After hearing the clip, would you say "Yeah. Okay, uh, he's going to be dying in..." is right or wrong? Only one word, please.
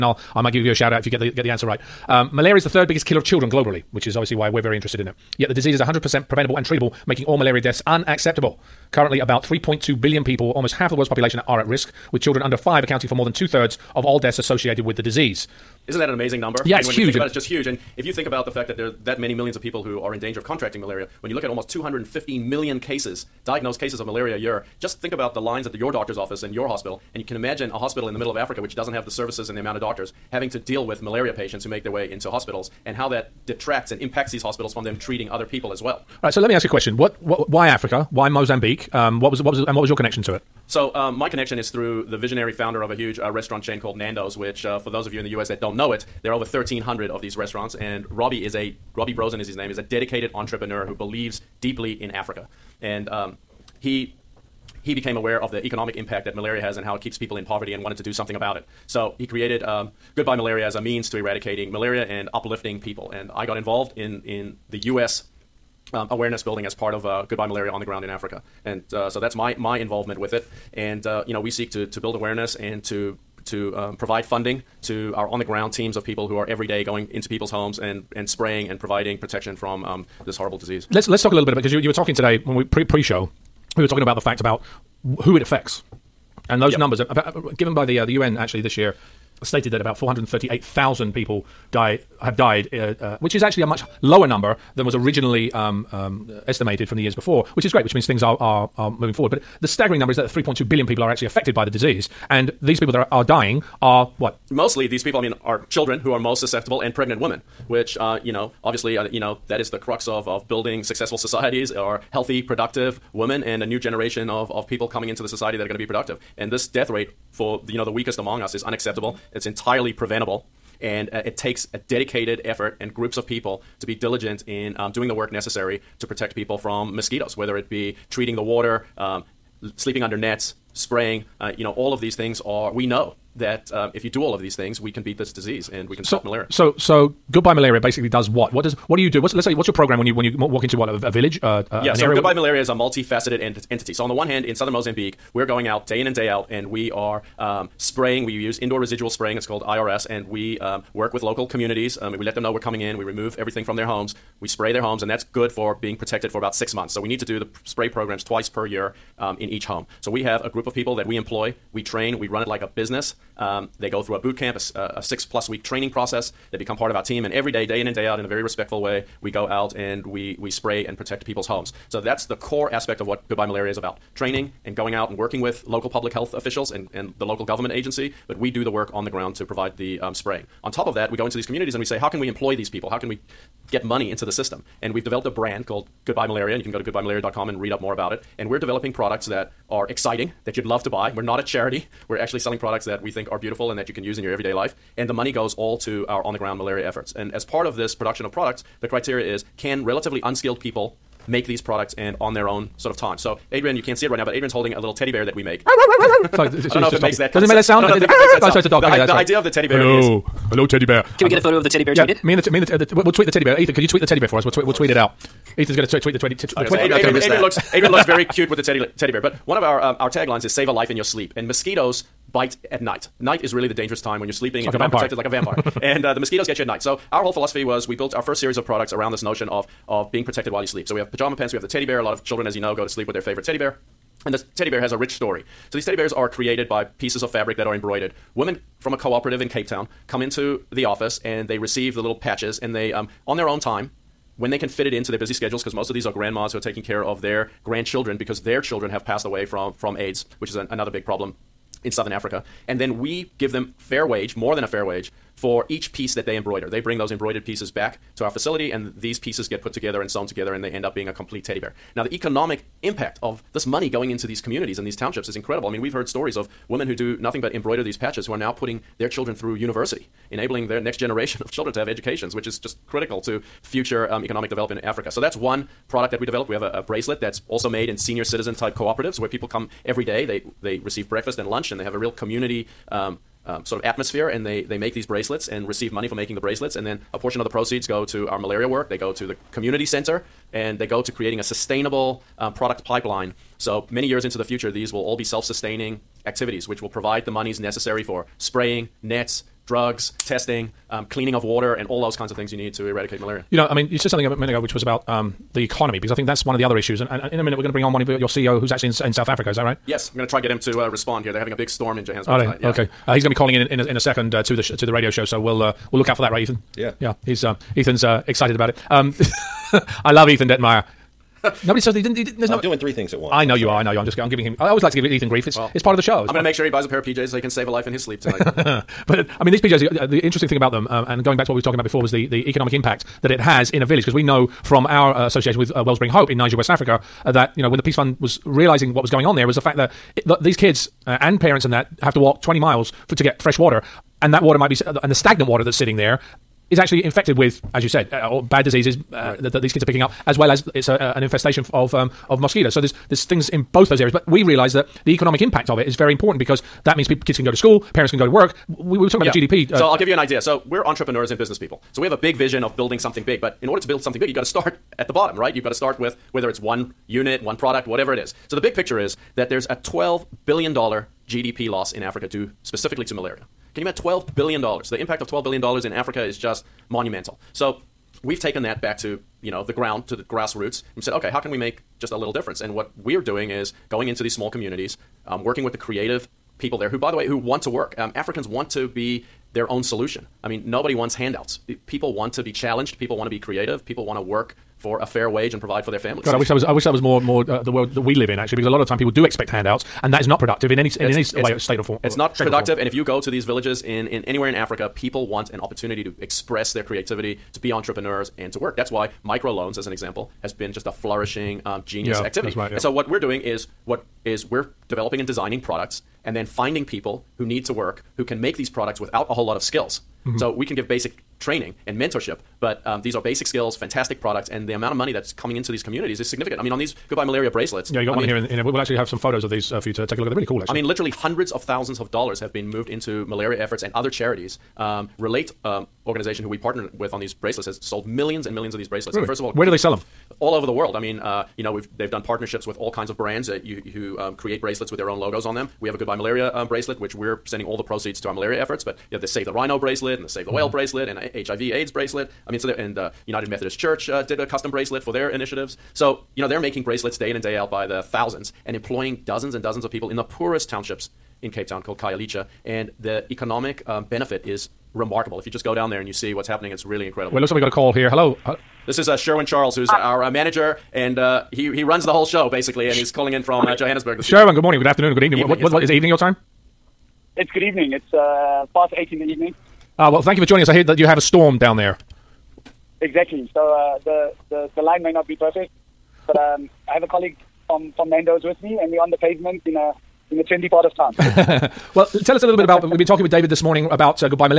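wrong.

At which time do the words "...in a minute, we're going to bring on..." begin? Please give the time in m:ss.
5:07.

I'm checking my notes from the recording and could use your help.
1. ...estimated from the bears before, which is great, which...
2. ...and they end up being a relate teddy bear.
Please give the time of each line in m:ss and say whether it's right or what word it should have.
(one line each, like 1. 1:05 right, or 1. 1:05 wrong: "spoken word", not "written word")
1. 1:36 wrong: "years", not "bears"
2. 4:20 wrong: "complete", not "relate".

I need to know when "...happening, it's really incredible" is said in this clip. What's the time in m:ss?
7:46.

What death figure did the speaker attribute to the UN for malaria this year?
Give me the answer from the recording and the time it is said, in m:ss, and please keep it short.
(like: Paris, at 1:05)
438,000, at 1:29.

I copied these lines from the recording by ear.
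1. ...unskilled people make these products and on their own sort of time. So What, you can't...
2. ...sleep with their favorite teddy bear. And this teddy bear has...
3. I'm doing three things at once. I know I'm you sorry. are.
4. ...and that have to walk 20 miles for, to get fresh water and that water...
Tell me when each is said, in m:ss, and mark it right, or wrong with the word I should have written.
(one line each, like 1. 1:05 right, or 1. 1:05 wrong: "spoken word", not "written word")
1. 3:20 wrong: "Adrian", not "What"
2. 3:52 right
3. 5:22 right
4. 5:41 right.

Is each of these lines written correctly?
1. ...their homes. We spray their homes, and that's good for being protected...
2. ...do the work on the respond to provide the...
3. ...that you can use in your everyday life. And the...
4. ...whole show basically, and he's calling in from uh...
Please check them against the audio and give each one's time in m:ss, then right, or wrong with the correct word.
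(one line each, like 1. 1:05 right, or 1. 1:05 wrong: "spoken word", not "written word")
1. 2:33 right
2. 2:58 wrong: "ground", not "respond"
3. 3:13 right
4. 7:52 right.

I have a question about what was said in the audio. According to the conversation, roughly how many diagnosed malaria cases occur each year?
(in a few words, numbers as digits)
215 million.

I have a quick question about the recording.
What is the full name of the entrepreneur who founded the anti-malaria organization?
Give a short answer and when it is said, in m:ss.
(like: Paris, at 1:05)
Robbie Brozin, at 0:48.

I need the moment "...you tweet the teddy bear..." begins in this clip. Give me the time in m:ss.
3:33.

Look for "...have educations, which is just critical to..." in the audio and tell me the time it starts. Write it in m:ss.
4:31.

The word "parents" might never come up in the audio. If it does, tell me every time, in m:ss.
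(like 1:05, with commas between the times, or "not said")
5:41, 5:57.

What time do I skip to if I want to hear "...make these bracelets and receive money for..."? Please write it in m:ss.
4:44.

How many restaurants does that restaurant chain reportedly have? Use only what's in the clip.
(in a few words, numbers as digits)
over 1,300.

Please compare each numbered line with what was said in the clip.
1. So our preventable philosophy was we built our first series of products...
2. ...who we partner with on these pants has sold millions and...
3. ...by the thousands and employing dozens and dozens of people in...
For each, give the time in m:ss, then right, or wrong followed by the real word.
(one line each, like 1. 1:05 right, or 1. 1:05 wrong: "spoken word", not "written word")
1. 3:46 wrong: "whole", not "preventable"
2. 7:16 wrong: "bracelets", not "pants"
3. 7:37 right.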